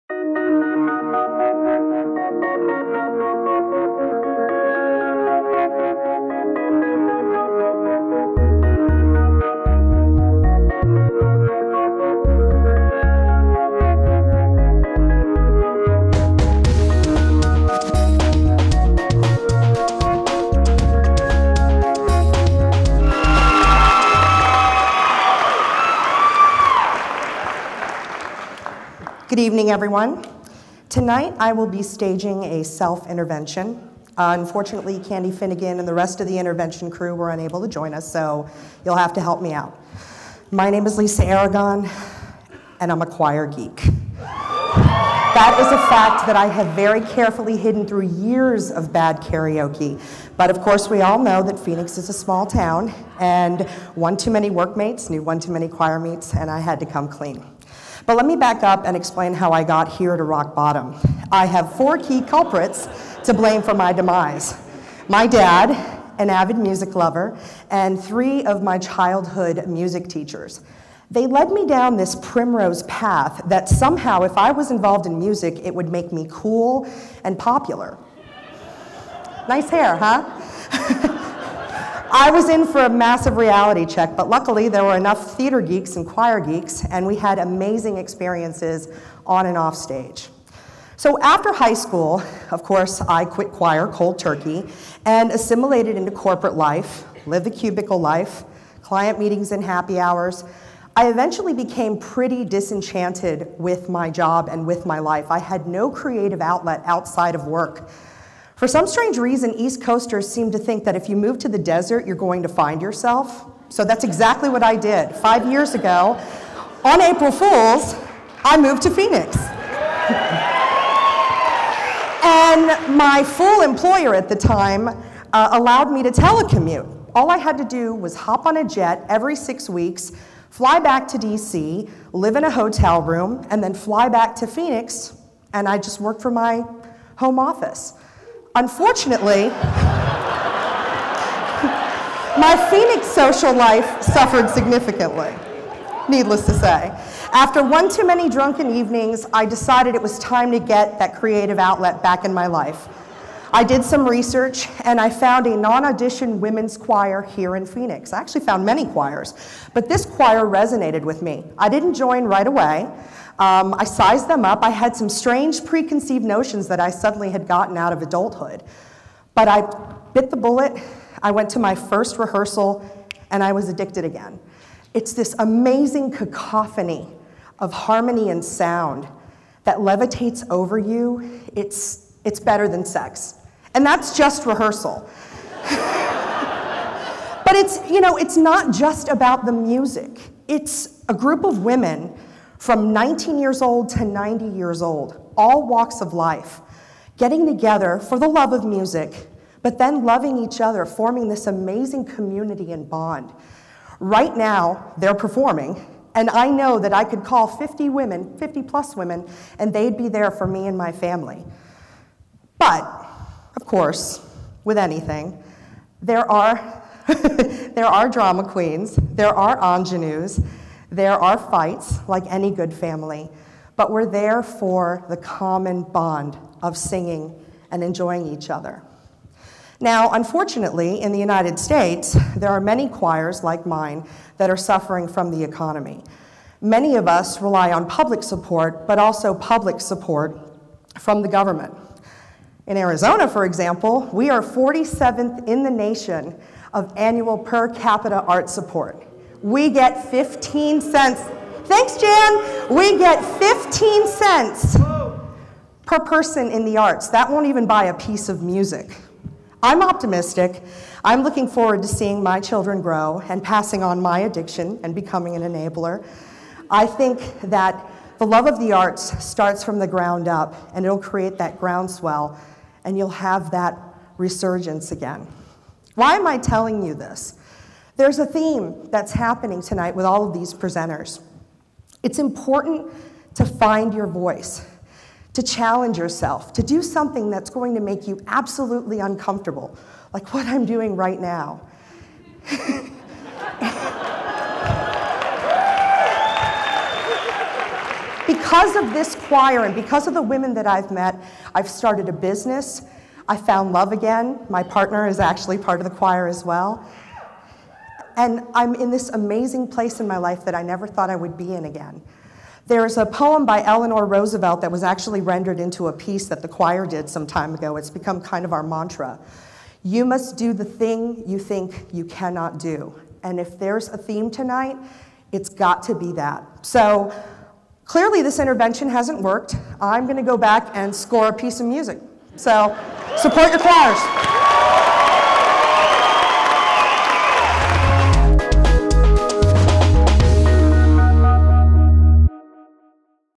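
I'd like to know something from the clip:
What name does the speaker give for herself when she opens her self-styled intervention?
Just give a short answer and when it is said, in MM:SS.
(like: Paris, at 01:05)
Lisa Aragon, at 00:40.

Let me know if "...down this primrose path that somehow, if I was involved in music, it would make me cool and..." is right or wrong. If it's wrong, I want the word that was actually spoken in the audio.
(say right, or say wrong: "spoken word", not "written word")
right.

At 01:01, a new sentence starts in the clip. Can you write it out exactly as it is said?
I have four key culprits to blame for my demise.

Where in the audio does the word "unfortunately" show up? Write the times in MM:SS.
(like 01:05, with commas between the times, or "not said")
00:34, 02:18, 03:50.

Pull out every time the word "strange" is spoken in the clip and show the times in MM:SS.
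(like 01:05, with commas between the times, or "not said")
01:48, 02:45.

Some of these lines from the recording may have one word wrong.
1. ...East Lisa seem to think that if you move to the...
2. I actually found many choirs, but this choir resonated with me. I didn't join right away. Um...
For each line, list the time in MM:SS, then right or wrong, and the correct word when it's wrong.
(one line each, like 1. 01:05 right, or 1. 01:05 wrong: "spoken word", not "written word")
1. 01:49 wrong: "Coasters", not "Lisa"
2. 02:38 right.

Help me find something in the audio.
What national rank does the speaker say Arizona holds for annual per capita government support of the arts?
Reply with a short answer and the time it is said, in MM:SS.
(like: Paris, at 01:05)
47th, at 04:04.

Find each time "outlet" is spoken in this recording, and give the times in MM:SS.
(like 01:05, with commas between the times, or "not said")
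01:46, 02:31.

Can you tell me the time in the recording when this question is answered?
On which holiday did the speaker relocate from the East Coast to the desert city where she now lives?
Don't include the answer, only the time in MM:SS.
01:57.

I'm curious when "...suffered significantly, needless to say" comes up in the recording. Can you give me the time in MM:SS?
02:24.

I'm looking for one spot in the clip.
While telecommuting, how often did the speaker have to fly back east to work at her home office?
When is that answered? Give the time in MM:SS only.
02:09.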